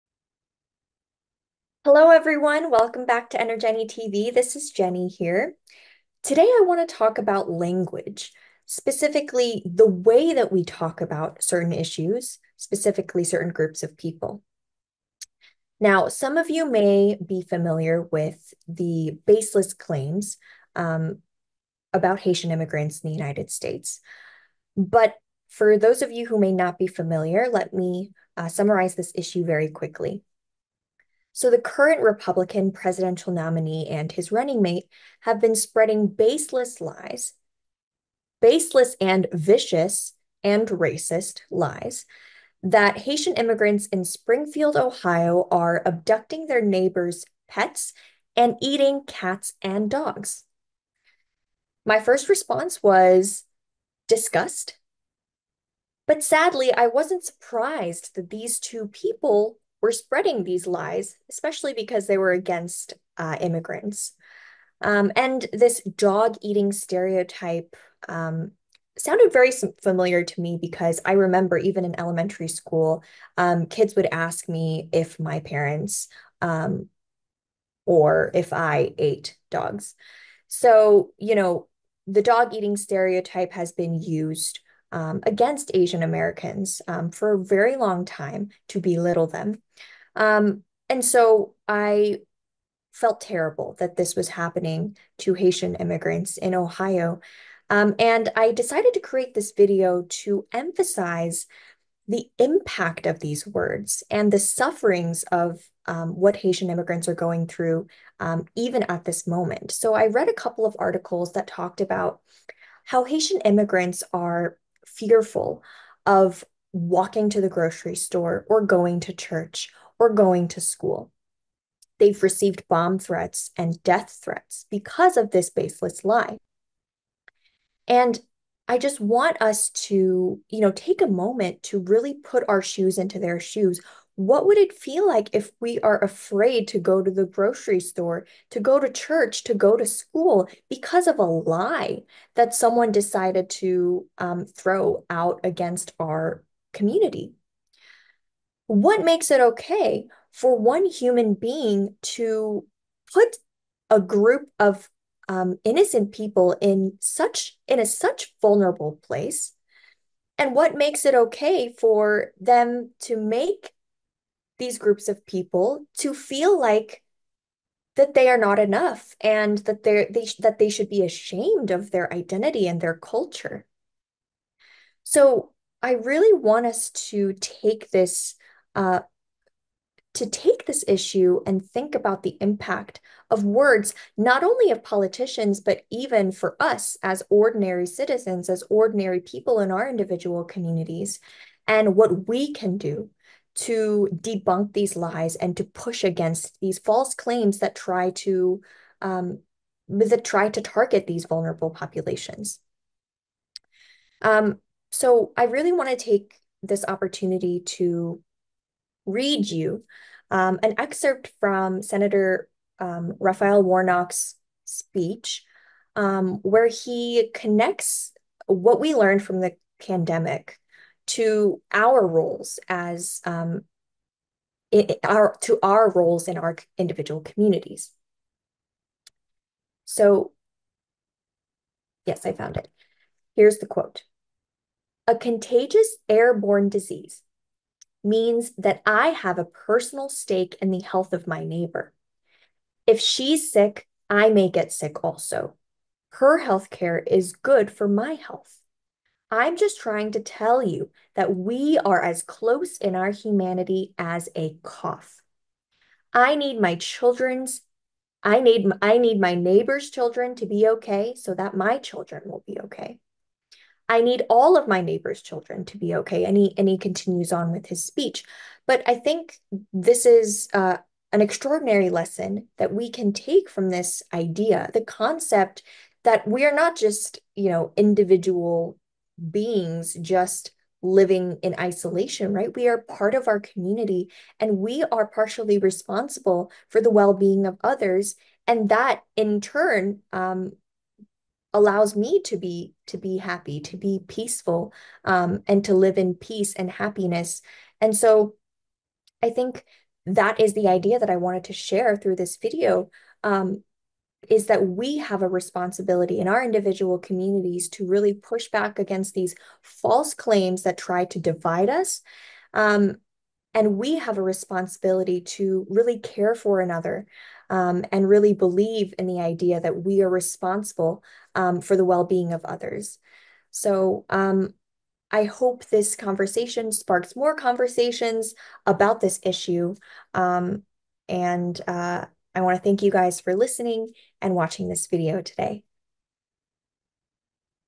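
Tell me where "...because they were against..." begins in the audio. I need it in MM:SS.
01:01.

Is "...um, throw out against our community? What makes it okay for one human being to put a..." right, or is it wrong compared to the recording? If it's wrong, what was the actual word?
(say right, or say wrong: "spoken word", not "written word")
right.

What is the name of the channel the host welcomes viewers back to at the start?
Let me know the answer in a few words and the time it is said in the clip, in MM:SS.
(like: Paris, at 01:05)
EnerJenny TV, at 00:03.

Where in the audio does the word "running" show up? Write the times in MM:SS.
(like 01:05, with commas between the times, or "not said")
00:34.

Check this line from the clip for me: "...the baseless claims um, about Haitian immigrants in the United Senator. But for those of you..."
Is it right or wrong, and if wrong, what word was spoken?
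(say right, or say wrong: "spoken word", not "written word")
wrong: "States", not "Senator".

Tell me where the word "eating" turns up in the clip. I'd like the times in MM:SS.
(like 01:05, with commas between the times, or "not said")
00:48, 01:06, 01:22.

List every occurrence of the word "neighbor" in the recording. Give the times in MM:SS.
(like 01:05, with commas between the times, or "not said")
00:46, 04:01, 04:19, 04:24.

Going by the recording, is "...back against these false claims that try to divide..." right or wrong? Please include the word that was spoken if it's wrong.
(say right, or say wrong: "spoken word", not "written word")
right.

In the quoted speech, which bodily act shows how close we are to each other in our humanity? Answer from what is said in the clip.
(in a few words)
A cough.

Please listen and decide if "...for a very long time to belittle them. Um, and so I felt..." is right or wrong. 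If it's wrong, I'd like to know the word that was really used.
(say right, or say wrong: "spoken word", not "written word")
right.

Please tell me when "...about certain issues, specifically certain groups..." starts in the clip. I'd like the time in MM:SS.
00:11.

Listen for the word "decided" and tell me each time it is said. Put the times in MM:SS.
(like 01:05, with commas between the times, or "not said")
01:38, 02:22.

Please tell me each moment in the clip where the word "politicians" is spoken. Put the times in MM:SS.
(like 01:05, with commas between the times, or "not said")
03:04.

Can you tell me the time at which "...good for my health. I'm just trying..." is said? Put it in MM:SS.
04:07.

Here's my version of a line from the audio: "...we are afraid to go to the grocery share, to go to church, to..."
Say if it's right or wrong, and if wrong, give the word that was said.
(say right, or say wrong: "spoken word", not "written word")
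wrong: "store", not "share".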